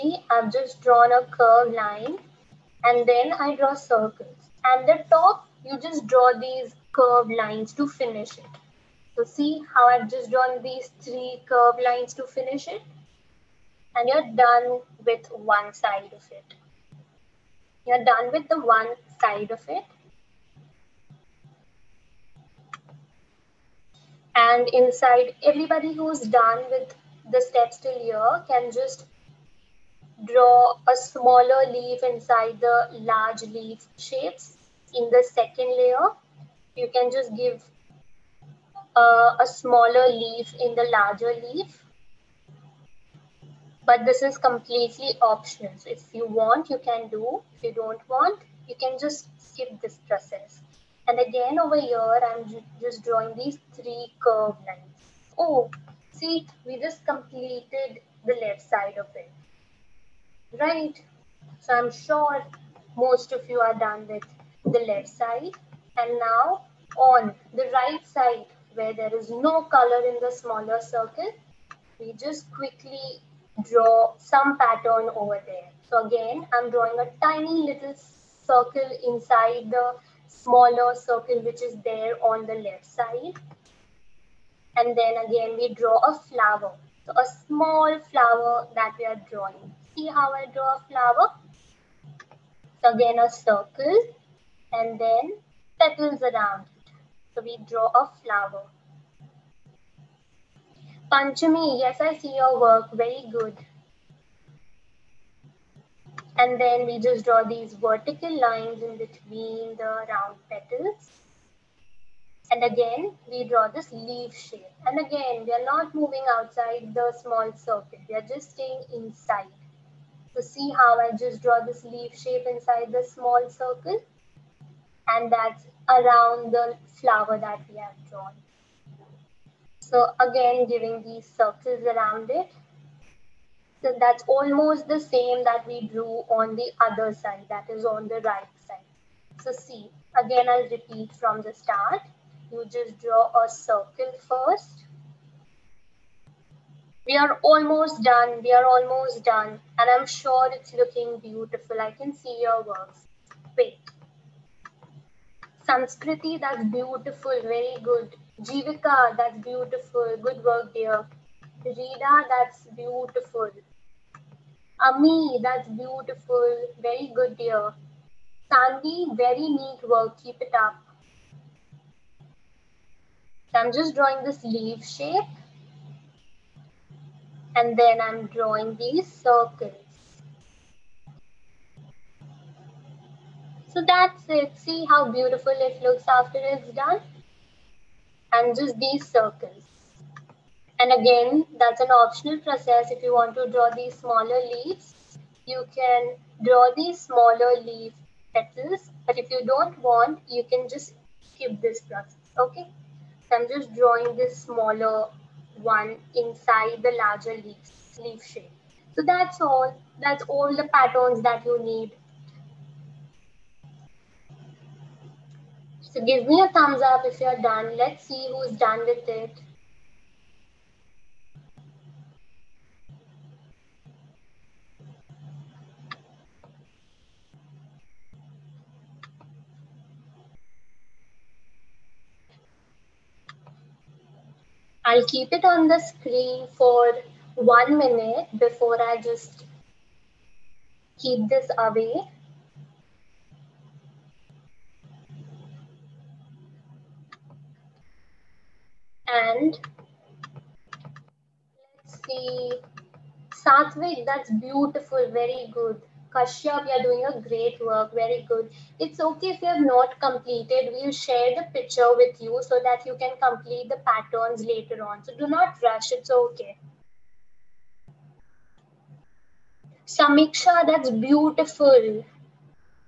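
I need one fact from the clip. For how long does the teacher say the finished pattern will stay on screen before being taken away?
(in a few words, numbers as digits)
1 minute.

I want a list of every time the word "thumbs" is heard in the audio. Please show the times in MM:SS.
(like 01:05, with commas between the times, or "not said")
03:36.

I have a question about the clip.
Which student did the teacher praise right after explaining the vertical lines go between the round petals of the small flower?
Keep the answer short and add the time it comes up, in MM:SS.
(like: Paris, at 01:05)
Panchami, at 01:41.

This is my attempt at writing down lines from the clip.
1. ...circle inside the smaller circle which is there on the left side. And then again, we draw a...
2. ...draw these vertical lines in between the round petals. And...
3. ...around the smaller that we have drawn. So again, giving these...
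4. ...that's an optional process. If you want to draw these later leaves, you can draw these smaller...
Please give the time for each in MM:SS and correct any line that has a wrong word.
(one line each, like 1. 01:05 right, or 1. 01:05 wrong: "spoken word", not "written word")
1. 01:18 right
2. 01:47 right
3. 02:05 wrong: "flower", not "smaller"
4. 03:11 wrong: "smaller", not "later".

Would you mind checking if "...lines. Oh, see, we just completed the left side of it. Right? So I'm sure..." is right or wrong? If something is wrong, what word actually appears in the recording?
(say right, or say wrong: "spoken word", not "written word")
right.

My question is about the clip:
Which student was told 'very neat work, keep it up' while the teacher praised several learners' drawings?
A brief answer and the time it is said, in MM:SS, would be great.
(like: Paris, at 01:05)
Sandy, at 02:48.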